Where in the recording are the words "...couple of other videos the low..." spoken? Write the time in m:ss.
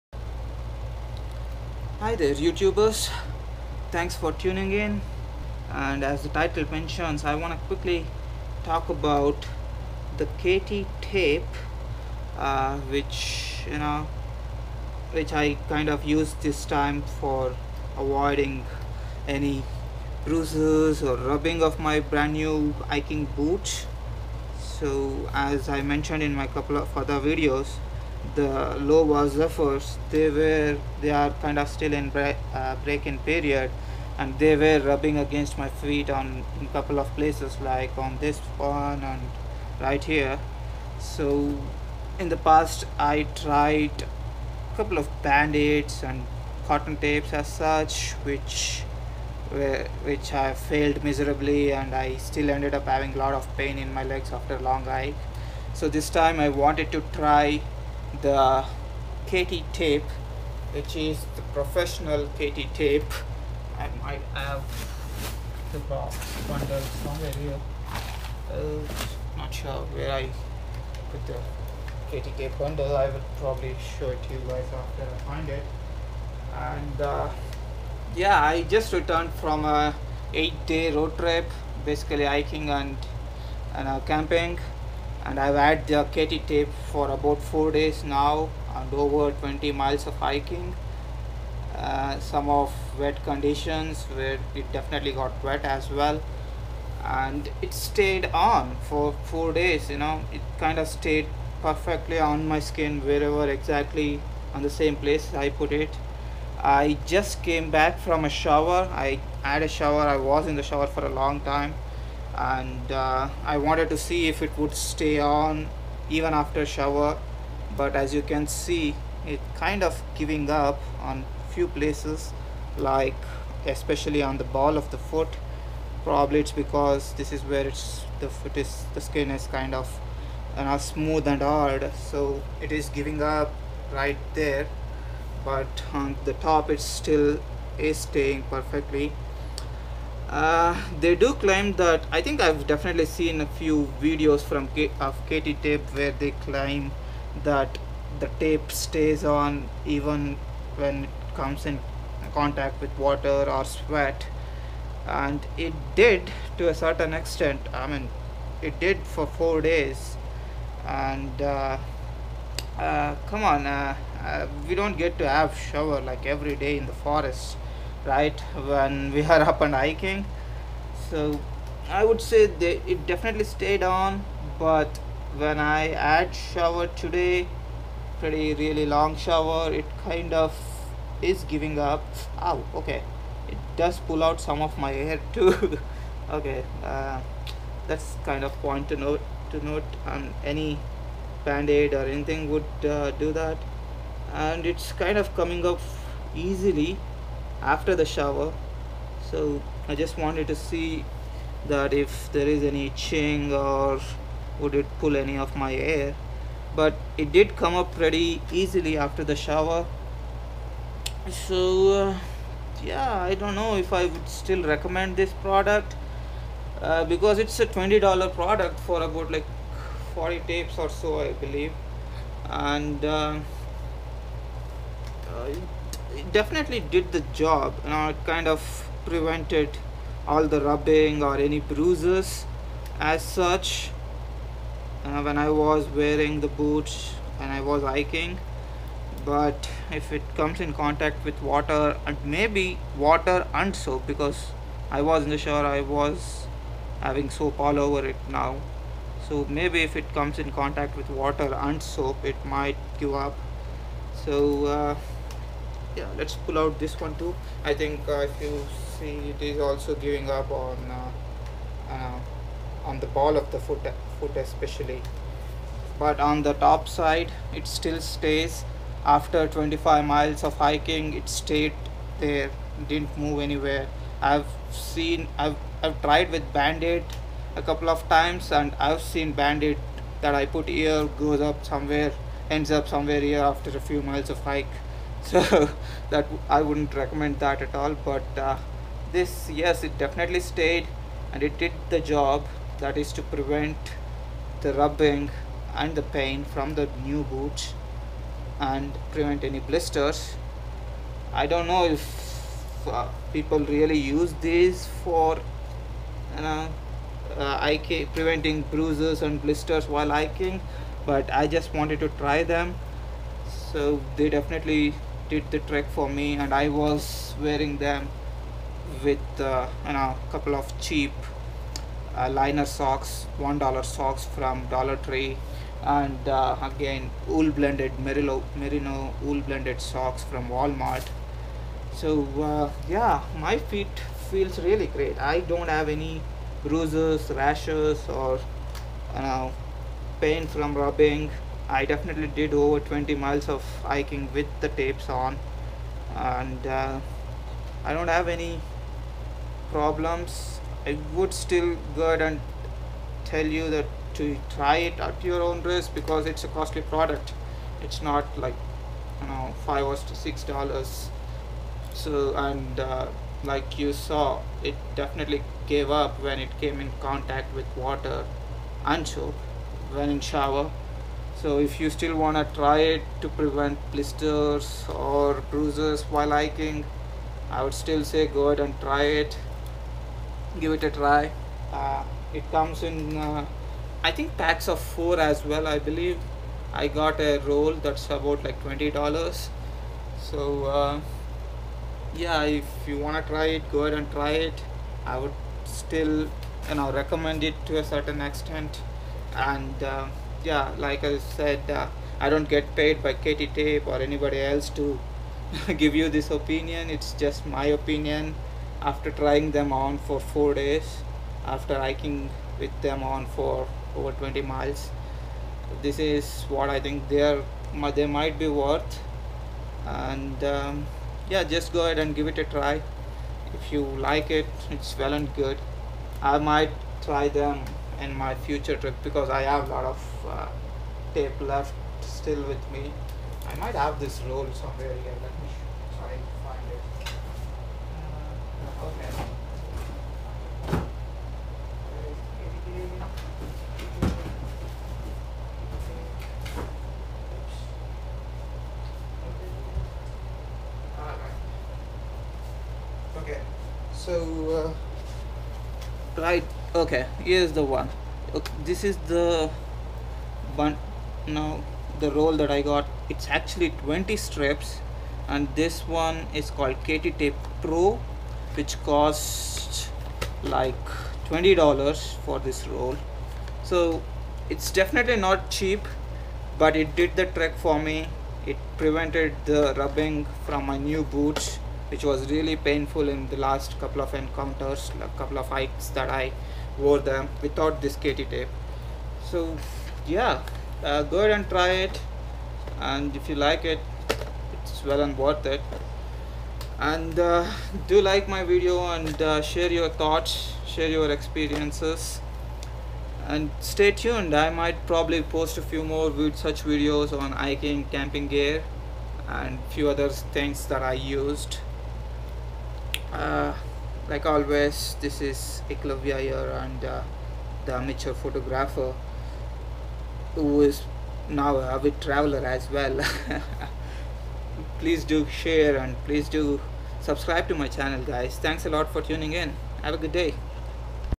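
0:26.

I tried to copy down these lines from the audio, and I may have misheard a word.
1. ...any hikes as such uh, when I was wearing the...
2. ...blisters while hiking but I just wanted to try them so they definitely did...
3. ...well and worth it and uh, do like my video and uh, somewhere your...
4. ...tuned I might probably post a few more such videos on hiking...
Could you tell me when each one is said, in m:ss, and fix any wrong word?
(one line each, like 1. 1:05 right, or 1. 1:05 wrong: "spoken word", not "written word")
1. 3:51 wrong: "bruises", not "hikes"
2. 5:09 right
3. 8:14 wrong: "share", not "somewhere"
4. 8:23 right.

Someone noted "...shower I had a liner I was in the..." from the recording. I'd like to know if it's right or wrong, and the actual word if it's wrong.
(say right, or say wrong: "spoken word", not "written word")
wrong: "shower", not "liner".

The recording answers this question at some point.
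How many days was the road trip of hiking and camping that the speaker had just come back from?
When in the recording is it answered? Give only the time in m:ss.
1:20.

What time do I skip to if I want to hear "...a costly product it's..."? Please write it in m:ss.
5:56.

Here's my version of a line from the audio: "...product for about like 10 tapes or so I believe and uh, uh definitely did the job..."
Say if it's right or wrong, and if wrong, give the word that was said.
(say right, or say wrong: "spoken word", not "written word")
wrong: "40", not "10".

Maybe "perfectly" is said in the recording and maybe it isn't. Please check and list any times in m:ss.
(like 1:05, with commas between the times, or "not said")
1:41, 2:18.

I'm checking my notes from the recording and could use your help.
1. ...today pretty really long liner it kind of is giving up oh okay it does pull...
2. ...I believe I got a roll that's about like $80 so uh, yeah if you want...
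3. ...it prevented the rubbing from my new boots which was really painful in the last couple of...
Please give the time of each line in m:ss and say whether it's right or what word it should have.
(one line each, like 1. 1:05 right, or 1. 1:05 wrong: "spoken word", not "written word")
1. 2:56 wrong: "shower", not "liner"
2. 6:25 wrong: "20", not "80"
3. 7:58 right.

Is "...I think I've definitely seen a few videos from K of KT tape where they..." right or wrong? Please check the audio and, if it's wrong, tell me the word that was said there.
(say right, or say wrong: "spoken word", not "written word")
right.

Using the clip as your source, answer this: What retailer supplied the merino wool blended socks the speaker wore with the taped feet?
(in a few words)
Walmart.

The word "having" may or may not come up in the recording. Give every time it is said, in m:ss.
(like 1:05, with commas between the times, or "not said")
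0:52, 4:07.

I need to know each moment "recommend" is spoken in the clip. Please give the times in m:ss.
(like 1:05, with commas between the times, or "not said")
3:34, 4:46, 6:36.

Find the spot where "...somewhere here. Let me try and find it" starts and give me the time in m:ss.
7:14.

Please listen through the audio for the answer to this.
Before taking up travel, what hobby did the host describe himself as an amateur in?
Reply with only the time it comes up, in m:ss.
8:38.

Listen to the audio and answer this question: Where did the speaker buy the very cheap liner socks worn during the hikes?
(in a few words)
Dollar Tree.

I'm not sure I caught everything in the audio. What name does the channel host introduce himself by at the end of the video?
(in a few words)
Eklavya.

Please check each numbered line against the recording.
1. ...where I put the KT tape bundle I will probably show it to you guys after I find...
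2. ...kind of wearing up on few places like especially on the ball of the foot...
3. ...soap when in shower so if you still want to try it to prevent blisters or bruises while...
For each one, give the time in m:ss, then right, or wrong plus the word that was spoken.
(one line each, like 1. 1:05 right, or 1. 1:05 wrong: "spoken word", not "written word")
1. 1:09 right
2. 1:59 wrong: "giving", not "wearing"
3. 6:09 right.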